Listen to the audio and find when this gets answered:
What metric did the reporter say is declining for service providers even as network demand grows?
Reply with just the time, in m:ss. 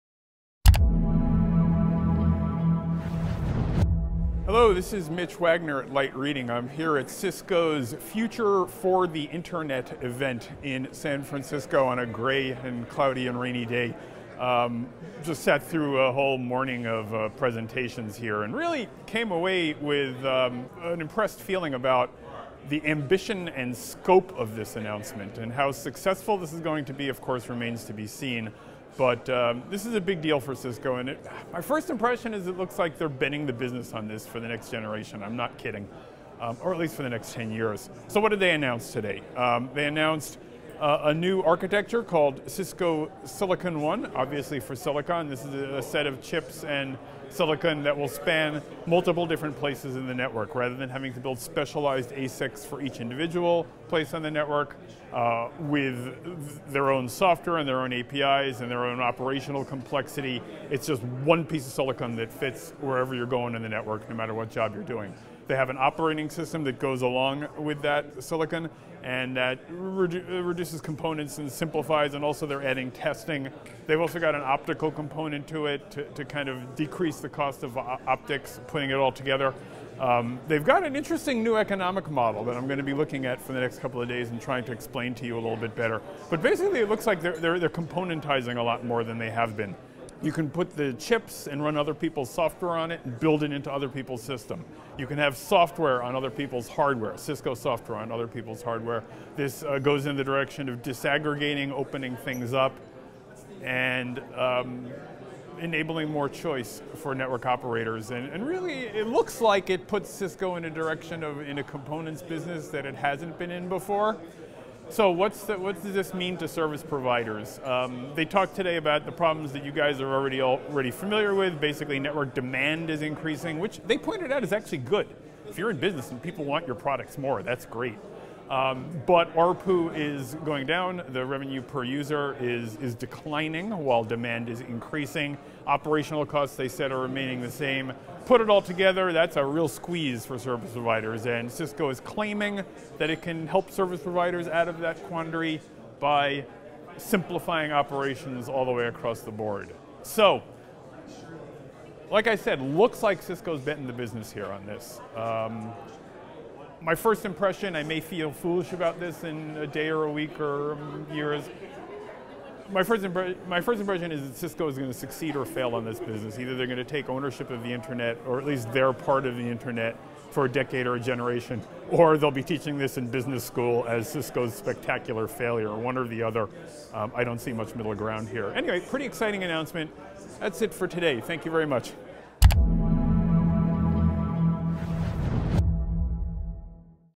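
2:09.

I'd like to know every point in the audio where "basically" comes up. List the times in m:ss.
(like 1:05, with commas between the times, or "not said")
1:26, 2:01.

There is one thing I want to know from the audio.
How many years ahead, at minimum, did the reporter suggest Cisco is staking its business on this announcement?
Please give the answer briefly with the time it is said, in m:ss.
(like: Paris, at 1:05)
10 years, at 0:37.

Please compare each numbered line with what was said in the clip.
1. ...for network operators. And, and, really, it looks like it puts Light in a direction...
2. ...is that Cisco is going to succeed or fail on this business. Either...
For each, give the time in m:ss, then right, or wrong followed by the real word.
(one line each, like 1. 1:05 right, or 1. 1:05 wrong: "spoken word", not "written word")
1. 1:46 wrong: "Cisco", not "Light"
2. 2:44 right.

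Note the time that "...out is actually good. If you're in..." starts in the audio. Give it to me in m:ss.
2:04.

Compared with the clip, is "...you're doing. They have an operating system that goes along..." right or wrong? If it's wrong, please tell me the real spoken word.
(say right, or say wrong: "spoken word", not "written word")
right.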